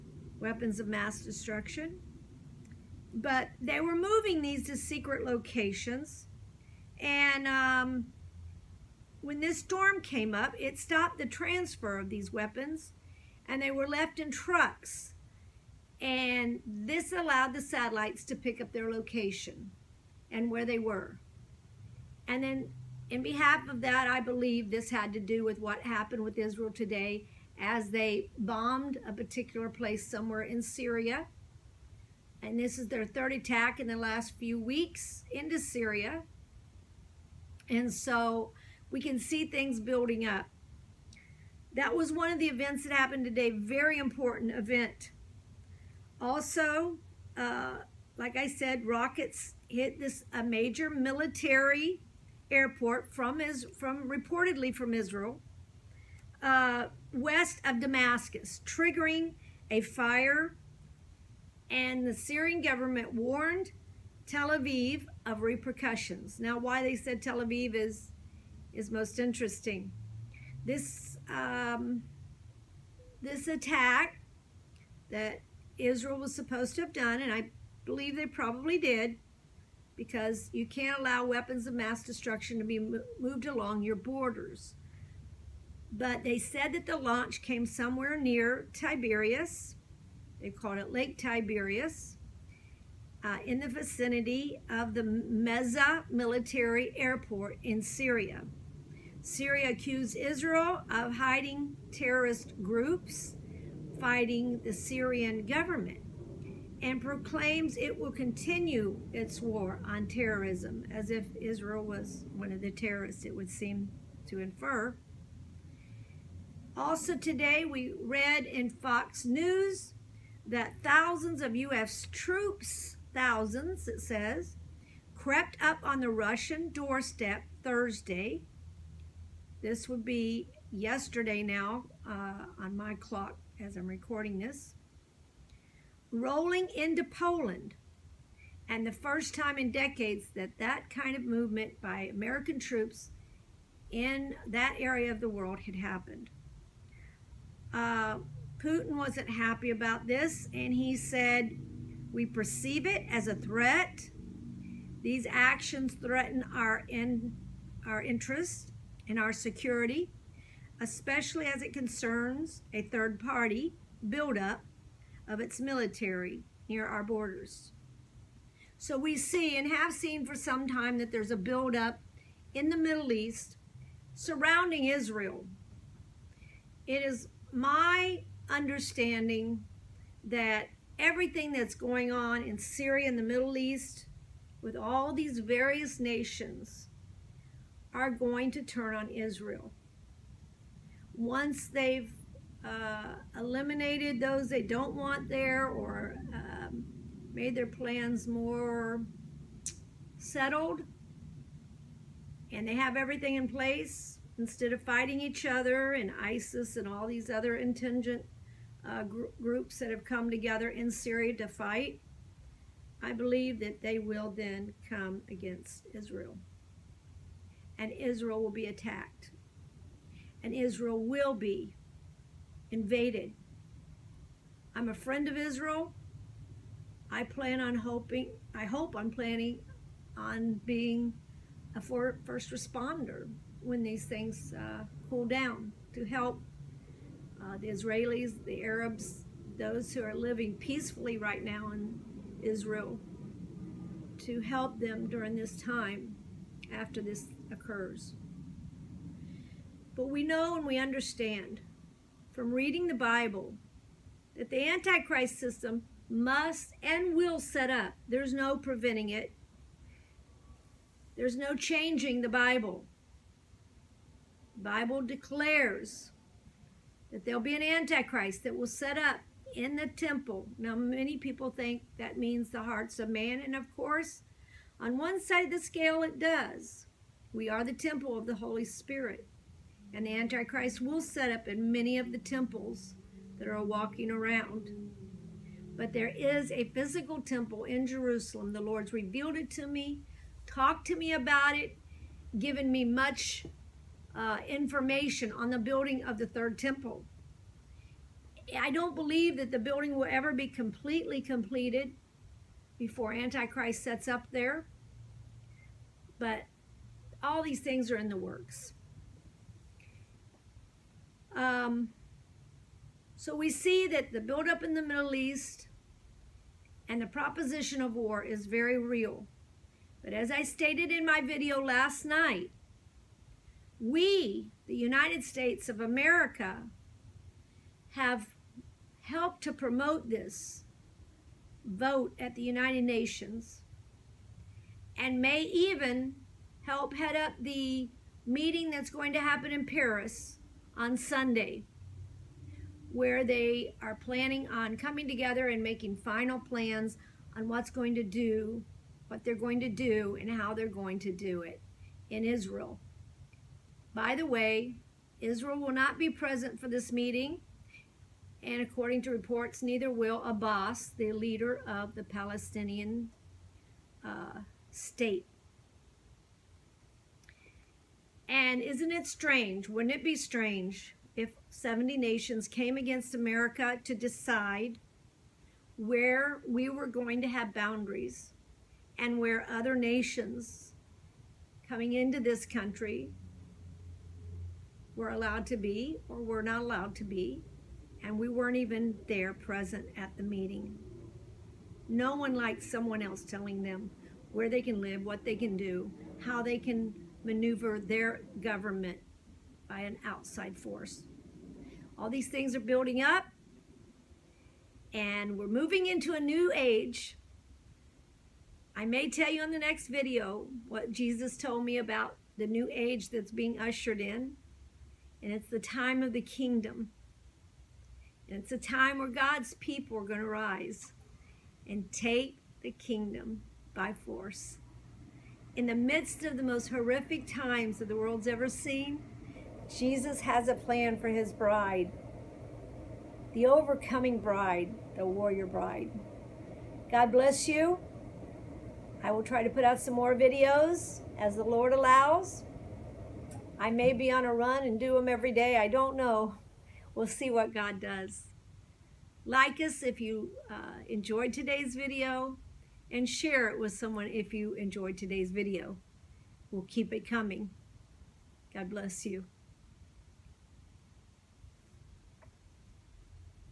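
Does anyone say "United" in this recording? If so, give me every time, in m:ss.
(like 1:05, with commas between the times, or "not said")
5:24, 5:32.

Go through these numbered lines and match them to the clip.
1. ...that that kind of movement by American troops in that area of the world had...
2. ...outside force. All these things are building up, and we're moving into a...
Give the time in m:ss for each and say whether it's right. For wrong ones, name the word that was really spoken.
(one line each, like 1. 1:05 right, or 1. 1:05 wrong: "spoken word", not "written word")
1. 2:20 right
2. 6:40 right.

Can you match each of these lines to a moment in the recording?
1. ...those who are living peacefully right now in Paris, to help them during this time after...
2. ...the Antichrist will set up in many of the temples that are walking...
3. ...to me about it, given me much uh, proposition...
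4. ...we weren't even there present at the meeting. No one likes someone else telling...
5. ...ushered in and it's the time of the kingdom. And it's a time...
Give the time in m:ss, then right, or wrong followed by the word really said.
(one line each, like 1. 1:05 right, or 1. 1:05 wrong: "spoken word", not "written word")
1. 3:59 wrong: "Israel", not "Paris"
2. 4:40 right
3. 4:50 wrong: "information", not "proposition"
4. 6:28 right
5. 6:53 right.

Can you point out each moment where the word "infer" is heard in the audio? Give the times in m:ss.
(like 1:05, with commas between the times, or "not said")
1:54.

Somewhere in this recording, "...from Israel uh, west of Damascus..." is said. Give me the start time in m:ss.
0:54.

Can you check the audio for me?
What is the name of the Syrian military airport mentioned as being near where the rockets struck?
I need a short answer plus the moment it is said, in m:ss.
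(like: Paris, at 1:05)
Mezzeh, at 1:35.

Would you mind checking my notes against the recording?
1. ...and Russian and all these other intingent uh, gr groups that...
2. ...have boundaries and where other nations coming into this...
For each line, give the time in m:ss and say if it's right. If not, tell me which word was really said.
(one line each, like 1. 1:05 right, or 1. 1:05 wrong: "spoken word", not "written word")
1. 3:25 wrong: "ISIS", not "Russian"
2. 6:17 right.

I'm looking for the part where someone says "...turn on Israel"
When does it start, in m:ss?
3:08.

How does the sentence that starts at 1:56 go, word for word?
Also today we read in Fox News that thousands of U.S.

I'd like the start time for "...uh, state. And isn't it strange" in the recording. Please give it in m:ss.
6:04.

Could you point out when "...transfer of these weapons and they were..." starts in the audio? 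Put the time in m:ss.
0:11.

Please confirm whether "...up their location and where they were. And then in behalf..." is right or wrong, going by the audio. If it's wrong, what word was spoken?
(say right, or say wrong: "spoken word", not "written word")
right.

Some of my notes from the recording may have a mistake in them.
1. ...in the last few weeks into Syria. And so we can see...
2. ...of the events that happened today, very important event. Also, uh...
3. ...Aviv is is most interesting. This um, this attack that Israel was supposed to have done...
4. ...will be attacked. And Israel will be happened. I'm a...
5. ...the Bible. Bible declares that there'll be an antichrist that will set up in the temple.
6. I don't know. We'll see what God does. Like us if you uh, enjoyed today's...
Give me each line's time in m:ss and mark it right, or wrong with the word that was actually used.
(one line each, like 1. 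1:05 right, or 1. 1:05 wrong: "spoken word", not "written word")
1. 0:33 right
2. 0:42 right
3. 1:07 right
4. 3:38 wrong: "invaded", not "happened"
5. 4:22 right
6. 7:25 right.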